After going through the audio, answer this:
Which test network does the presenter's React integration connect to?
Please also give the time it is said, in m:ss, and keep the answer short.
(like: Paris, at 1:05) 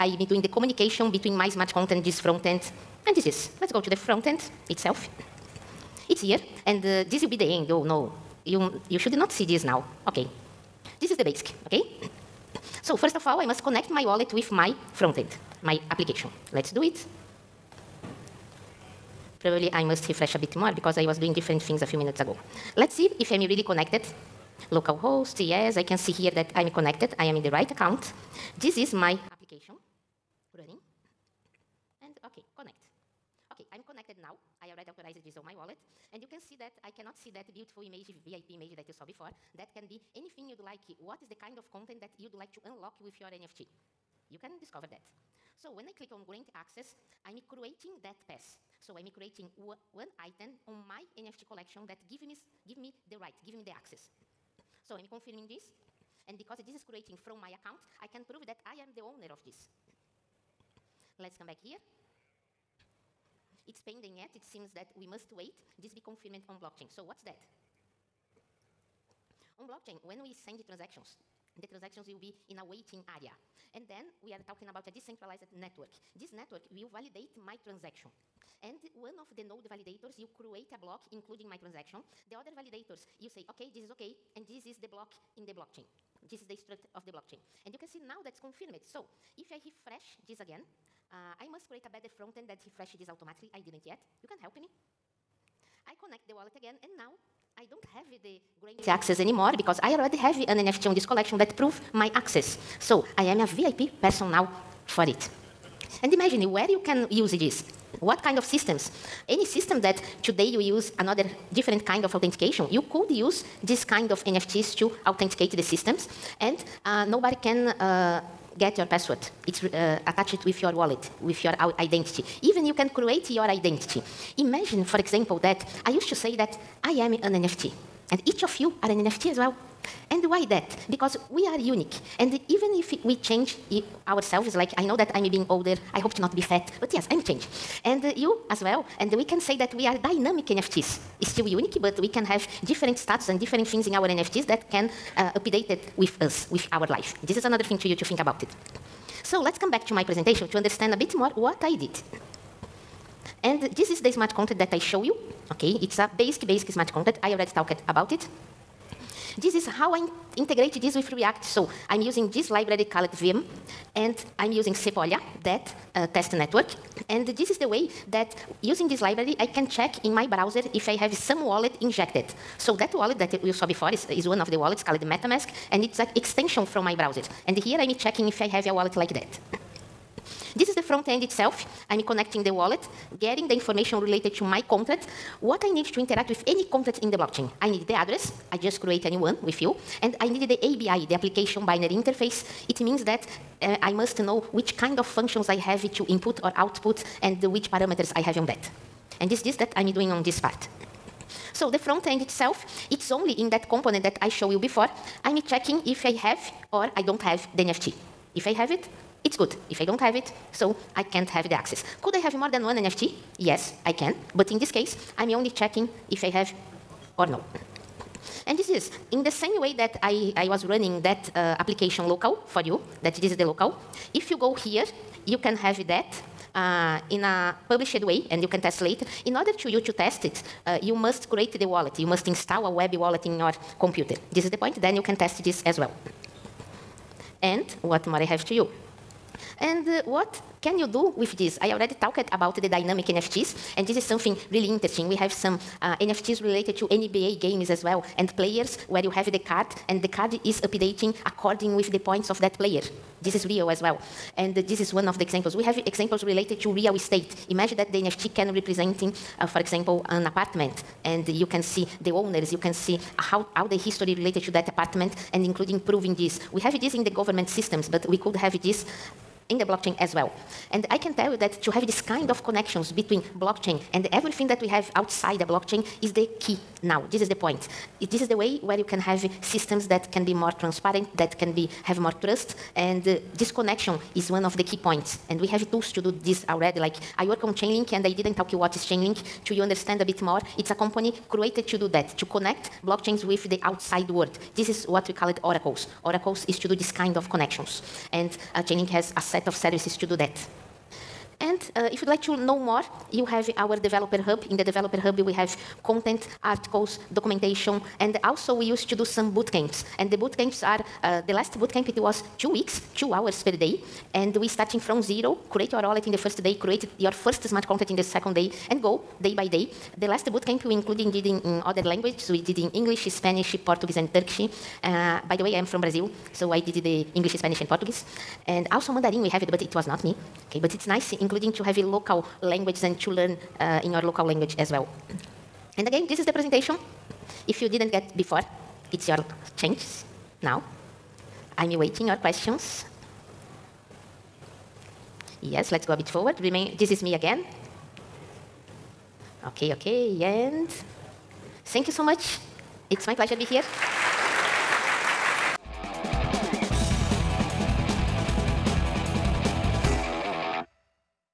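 Sepolia, at 2:44.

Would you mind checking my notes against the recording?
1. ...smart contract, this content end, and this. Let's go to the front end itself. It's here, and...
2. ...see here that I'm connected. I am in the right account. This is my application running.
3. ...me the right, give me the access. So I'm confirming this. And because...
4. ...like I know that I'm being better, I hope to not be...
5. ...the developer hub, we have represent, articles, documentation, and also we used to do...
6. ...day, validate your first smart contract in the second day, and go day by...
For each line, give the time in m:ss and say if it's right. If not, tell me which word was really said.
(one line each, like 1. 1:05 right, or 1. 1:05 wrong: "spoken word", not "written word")
1. 0:01 wrong: "front", not "content"
2. 0:25 right
3. 0:52 right
4. 2:14 wrong: "older", not "better"
5. 5:04 wrong: "content", not "represent"
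6. 5:16 wrong: "create", not "validate".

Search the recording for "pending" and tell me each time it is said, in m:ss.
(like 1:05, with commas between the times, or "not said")
1:03.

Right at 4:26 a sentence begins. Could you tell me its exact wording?
We have this in the government systems, but we could have this in the blockchain as well.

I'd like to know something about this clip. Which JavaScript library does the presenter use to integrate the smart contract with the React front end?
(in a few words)
viem.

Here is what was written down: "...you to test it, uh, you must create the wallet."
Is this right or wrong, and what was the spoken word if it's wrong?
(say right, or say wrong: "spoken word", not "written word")
right.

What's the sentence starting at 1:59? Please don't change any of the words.
It's uh, attached with your wallet, with your identity.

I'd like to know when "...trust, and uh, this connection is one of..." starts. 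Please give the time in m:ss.
4:42.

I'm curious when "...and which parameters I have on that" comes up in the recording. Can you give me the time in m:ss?
3:17.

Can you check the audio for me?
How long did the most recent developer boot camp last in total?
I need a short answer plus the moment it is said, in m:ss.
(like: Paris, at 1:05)
Two weeks, at 5:12.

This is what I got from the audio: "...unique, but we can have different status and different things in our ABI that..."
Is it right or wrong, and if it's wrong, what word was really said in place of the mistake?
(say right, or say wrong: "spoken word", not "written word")
wrong: "NFTs", not "ABI".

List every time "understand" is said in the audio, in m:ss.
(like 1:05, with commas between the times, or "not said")
2:30, 4:49.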